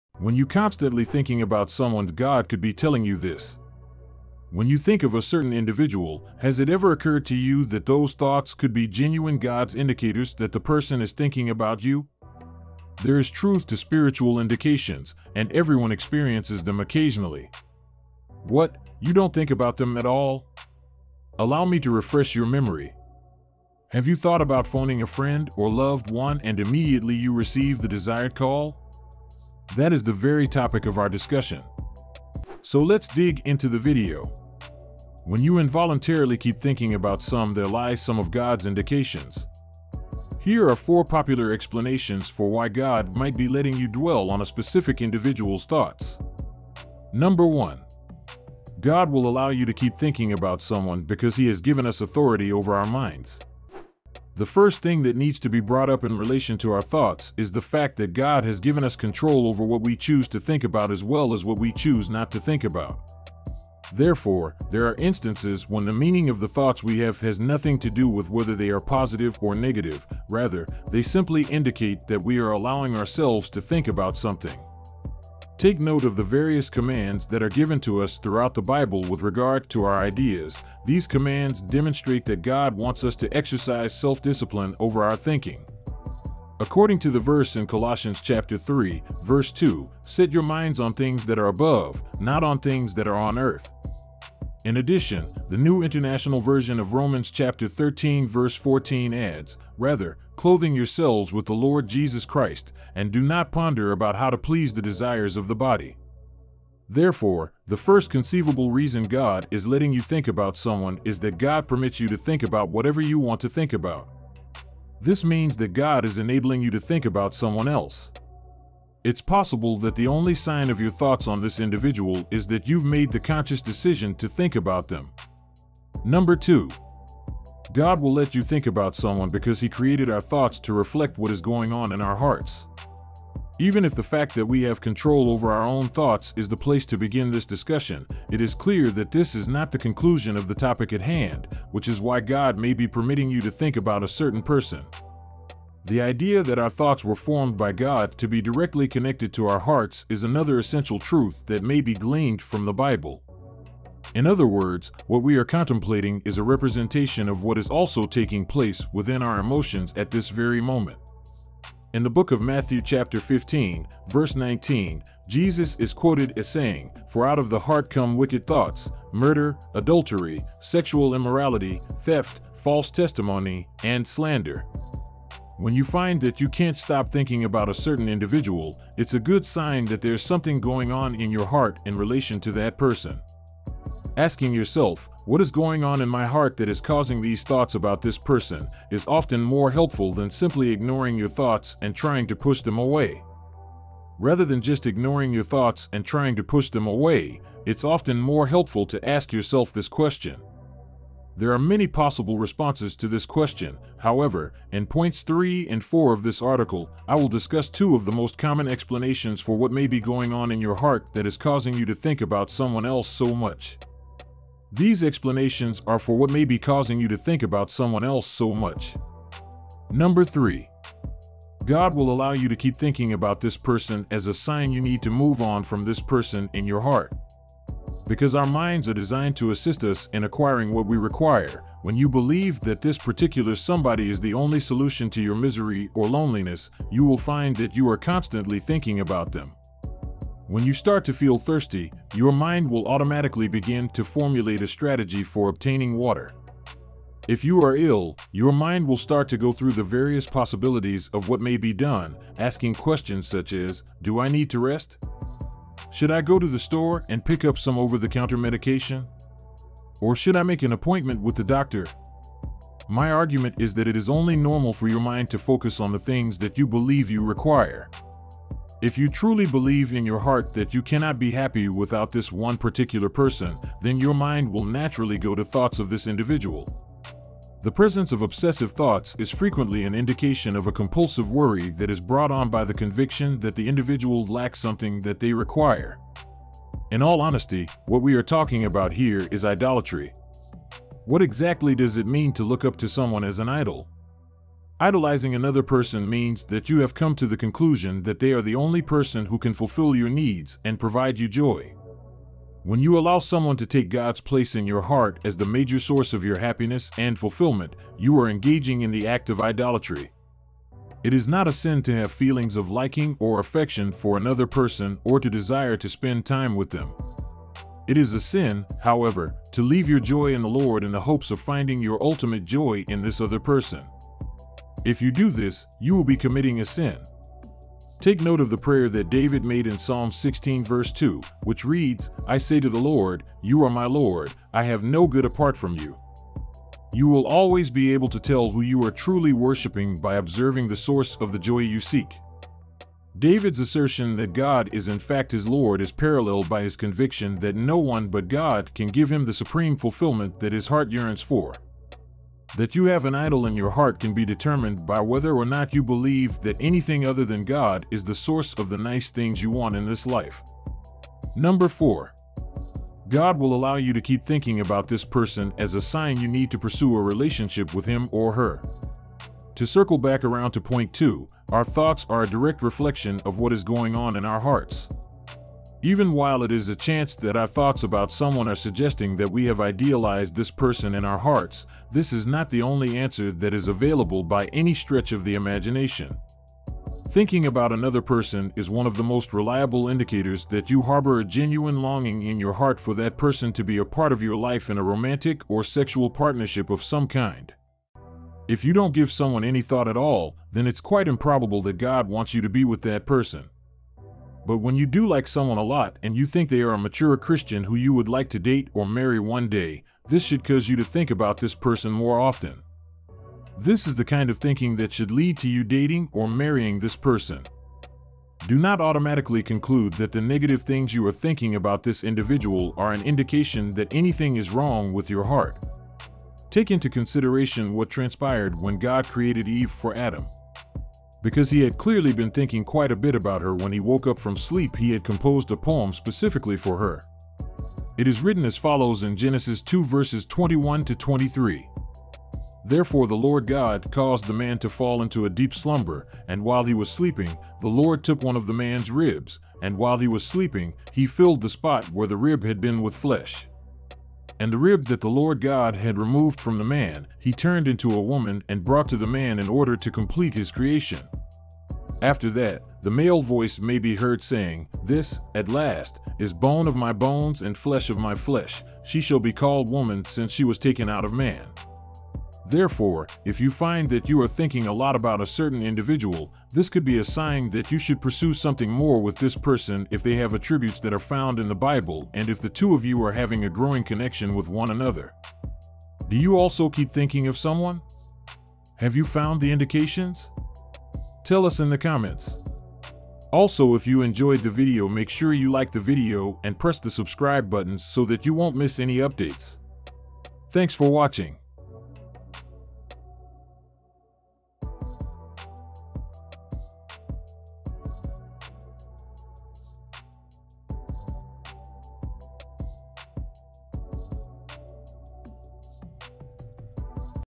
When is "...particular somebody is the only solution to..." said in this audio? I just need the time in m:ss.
3:52.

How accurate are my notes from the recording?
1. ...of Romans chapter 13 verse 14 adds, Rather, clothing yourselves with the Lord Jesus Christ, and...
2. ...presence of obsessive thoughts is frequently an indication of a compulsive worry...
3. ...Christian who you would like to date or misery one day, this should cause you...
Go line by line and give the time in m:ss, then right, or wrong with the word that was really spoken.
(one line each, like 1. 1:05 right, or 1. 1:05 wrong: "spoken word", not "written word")
1. 1:36 right
2. 4:37 right
3. 6:47 wrong: "marry", not "misery".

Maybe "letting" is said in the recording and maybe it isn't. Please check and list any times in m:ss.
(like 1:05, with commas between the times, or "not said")
0:43, 1:49.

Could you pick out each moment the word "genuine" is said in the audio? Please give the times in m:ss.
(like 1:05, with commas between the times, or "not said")
0:08, 6:31.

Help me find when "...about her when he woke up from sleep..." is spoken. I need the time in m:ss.
7:13.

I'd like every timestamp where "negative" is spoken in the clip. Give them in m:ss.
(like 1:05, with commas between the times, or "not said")
1:09, 7:00.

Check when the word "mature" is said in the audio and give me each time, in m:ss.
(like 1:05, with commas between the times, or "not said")
6:46.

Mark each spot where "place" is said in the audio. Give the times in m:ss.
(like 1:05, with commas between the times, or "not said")
2:16, 2:38, 5:04.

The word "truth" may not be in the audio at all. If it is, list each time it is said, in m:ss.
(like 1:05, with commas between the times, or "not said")
0:13, 2:30.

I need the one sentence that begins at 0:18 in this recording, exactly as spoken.
What, you don't think about them at all?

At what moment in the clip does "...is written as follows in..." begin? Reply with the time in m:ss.
7:18.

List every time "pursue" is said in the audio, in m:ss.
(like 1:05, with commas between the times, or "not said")
6:06, 7:58.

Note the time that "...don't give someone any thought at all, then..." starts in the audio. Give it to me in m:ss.
6:38.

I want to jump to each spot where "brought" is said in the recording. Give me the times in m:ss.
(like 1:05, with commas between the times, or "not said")
0:55, 4:41, 7:38.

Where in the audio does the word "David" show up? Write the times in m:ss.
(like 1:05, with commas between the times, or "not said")
5:29, 5:43.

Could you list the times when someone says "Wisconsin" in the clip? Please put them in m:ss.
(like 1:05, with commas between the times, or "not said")
not said.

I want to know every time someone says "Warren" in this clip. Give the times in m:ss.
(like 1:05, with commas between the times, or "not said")
not said.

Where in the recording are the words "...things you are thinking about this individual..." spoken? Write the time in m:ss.
7:00.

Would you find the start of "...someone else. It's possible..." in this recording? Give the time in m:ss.
1:57.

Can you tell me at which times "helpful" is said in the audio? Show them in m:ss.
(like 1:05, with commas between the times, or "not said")
3:09, 3:18.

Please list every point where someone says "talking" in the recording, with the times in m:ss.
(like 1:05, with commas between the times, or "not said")
4:48.